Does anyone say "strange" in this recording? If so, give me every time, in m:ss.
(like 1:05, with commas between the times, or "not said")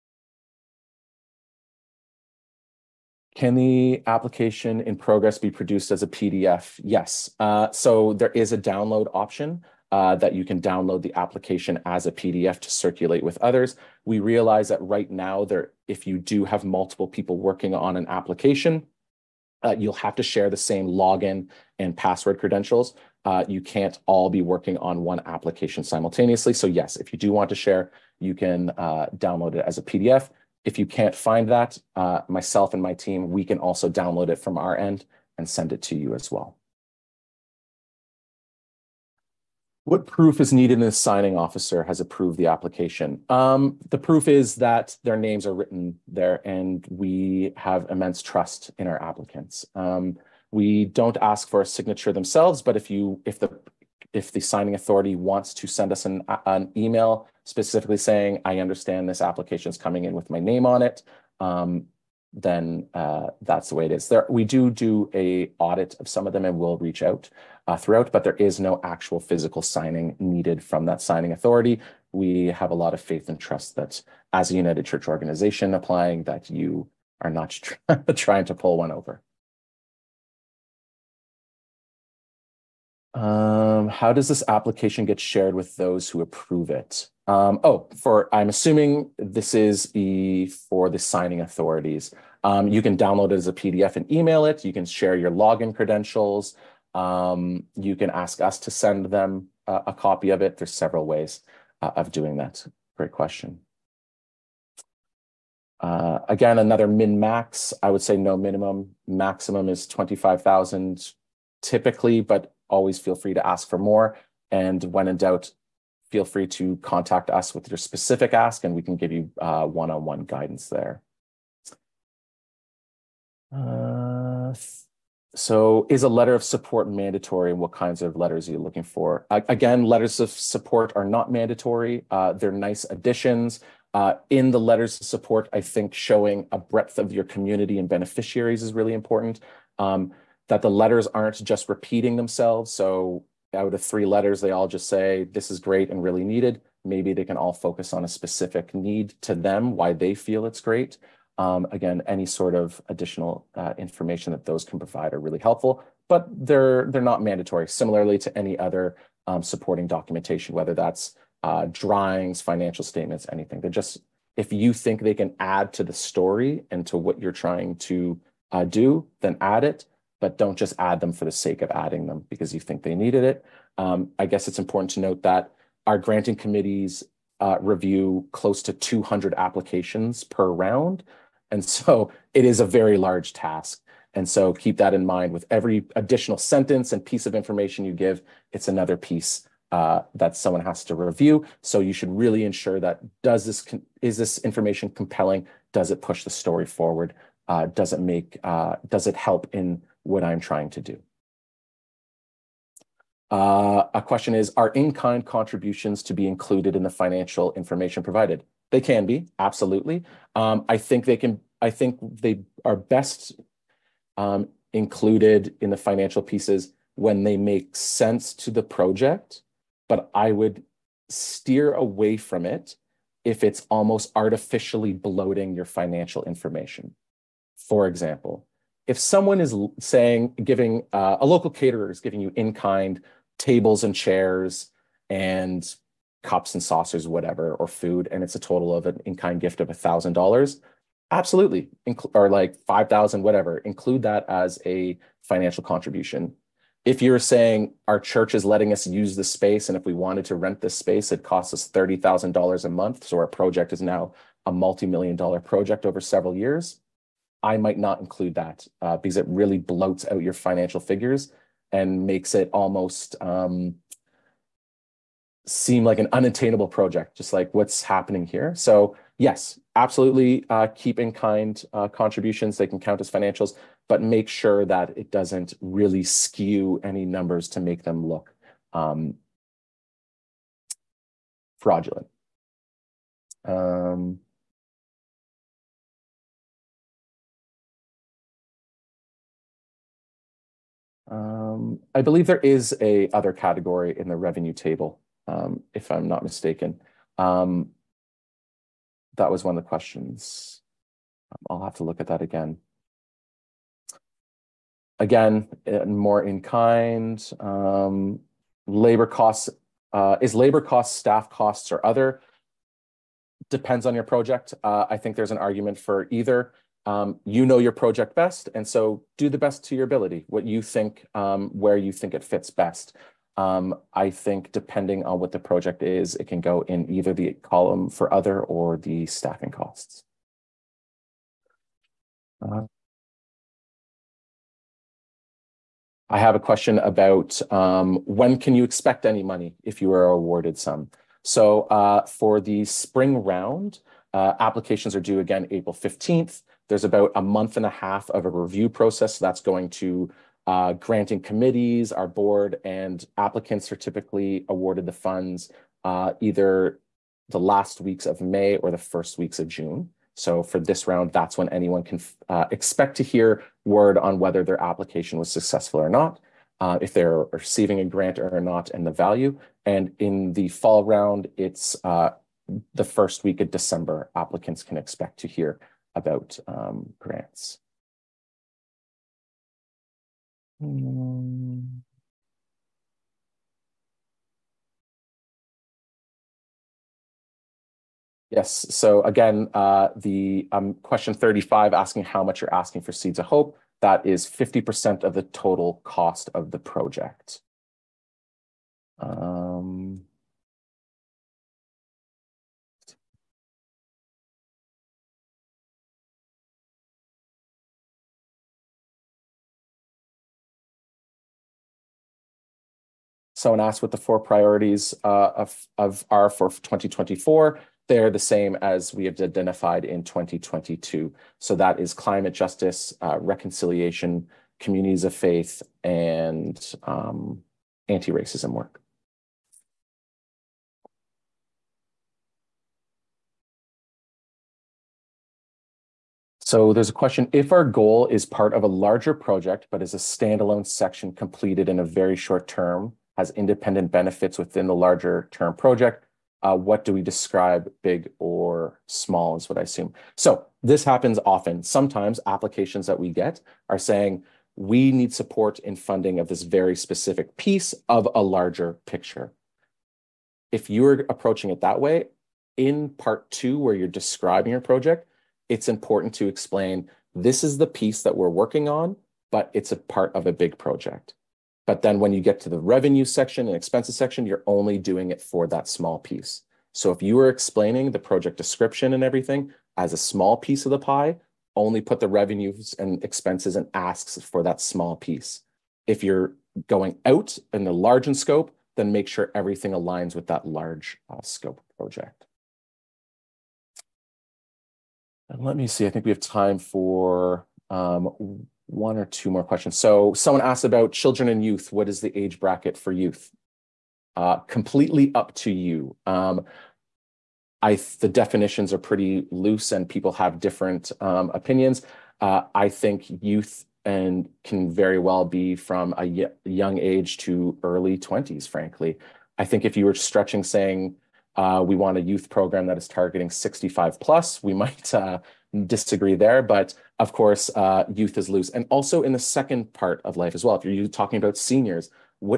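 not said.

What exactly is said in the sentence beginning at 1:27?
Um, oh, for I'm assuming this is for the signing authorities.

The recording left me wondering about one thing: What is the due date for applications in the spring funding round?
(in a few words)
April 15th.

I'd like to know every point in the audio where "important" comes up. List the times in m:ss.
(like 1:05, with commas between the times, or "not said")
2:18, 2:54, 7:45.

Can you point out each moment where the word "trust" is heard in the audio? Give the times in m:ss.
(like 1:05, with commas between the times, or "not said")
0:48, 1:13.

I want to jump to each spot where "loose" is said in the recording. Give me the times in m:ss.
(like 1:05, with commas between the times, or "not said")
8:29, 8:48.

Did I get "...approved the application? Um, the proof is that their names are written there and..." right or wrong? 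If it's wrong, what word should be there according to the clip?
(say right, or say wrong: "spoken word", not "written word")
right.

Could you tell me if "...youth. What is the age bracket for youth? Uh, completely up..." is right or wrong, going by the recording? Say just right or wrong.
right.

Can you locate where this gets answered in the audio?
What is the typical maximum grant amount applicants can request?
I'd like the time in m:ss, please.
1:49.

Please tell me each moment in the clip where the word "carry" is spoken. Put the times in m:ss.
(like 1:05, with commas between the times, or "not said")
not said.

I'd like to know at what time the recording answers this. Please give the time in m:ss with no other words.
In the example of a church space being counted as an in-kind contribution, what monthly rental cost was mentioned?
4:11.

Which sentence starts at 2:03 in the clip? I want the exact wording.
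Uh, so is a letter of support mandatory and what kinds of letters are you looking for?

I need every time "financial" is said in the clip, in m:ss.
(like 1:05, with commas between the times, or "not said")
2:42, 3:26, 3:35, 3:45, 4:05, 4:20, 4:33.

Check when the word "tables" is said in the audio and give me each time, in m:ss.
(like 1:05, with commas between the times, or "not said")
3:53, 4:54.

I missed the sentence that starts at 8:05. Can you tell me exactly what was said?
If you're going out in the large in scope, then make sure everything aligns with that large uh, scope project.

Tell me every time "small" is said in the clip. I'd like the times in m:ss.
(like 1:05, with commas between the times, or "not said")
7:28, 7:55, 7:59, 8:04.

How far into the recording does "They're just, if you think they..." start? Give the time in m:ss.
2:43.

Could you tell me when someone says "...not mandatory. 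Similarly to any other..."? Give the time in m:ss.
2:37.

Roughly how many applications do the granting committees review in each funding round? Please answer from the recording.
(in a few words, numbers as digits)
200.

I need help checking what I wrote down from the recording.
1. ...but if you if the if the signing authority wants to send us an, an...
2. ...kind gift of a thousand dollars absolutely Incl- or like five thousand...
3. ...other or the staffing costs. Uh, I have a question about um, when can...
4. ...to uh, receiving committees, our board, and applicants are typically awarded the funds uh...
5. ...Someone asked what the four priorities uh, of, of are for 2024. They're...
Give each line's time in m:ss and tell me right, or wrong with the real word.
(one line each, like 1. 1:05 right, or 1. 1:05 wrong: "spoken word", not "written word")
1. 0:52 right
2. 3:59 right
3. 5:28 right
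4. 5:49 wrong: "granting", not "receiving"
5. 6:53 right.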